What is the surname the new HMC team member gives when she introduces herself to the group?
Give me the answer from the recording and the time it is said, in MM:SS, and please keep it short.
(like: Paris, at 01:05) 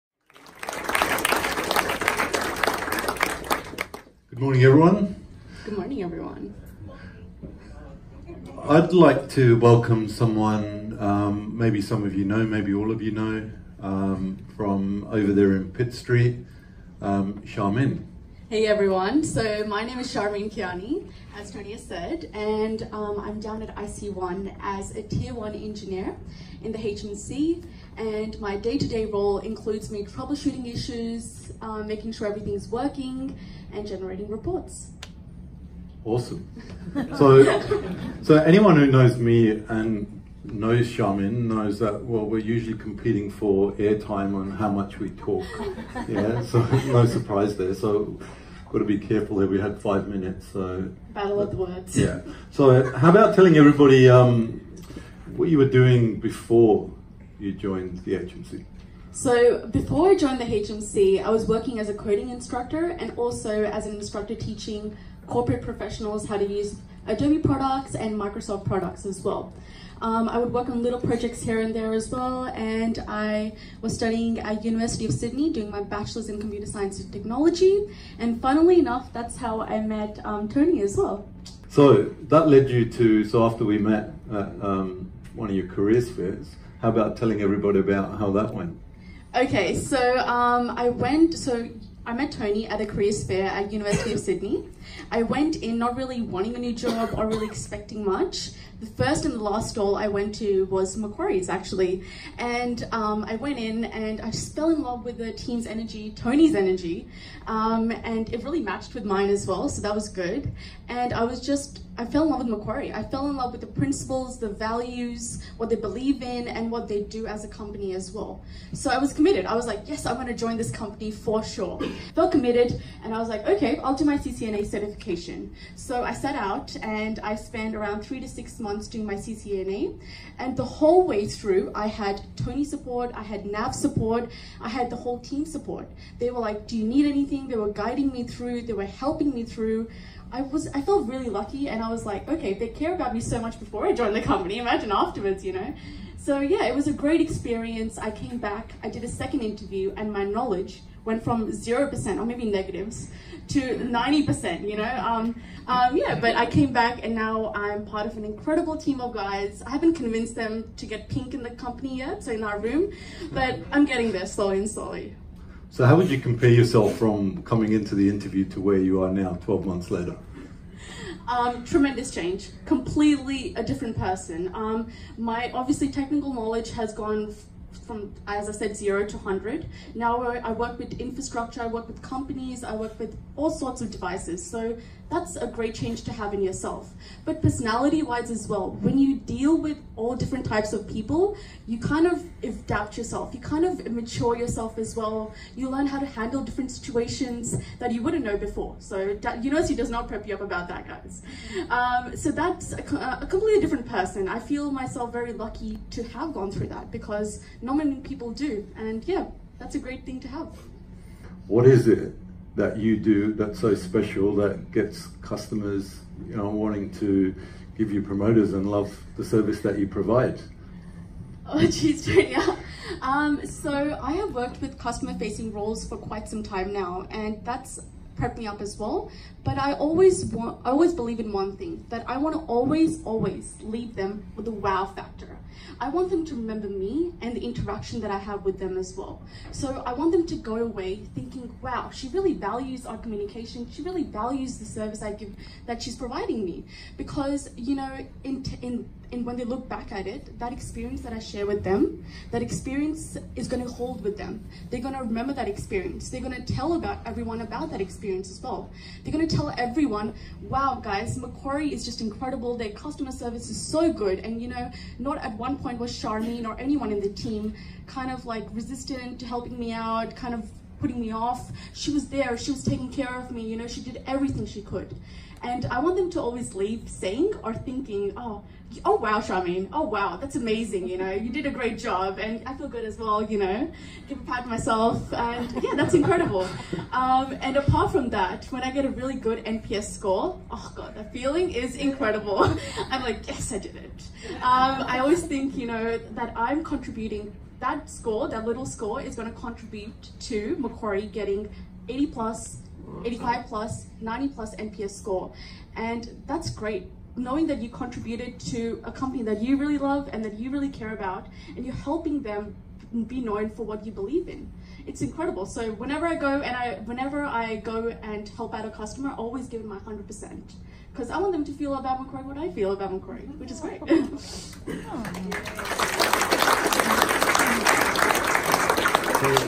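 Kayani, at 00:20.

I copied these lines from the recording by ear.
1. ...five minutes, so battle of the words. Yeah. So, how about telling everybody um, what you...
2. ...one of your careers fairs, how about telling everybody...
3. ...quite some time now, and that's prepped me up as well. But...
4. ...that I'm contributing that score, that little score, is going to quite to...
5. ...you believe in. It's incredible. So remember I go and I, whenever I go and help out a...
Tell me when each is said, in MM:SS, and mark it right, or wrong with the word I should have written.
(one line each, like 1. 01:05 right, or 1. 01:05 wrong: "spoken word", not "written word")
1. 00:49 right
2. 01:25 right
3. 03:45 right
4. 04:55 wrong: "contribute", not "quite"
5. 05:13 wrong: "whenever", not "remember".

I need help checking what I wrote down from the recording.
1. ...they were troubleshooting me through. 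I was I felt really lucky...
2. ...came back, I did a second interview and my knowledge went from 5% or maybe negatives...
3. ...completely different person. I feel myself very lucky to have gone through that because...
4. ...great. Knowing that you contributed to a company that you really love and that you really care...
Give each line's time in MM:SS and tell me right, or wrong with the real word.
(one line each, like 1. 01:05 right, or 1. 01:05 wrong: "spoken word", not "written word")
1. 02:18 wrong: "helping", not "troubleshooting"
2. 02:28 wrong: "0", not "5"
3. 03:23 right
4. 05:06 right.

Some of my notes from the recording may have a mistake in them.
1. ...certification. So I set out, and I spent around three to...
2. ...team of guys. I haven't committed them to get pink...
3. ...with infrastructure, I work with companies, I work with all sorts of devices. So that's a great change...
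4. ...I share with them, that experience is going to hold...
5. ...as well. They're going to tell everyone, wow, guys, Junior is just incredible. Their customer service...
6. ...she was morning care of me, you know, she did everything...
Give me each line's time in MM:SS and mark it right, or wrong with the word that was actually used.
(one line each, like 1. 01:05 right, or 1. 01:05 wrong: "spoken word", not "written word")
1. 02:04 right
2. 02:38 wrong: "convinced", not "committed"
3. 03:00 right
4. 04:11 right
5. 04:18 wrong: "Macquarie", not "Junior"
6. 04:32 wrong: "taking", not "morning".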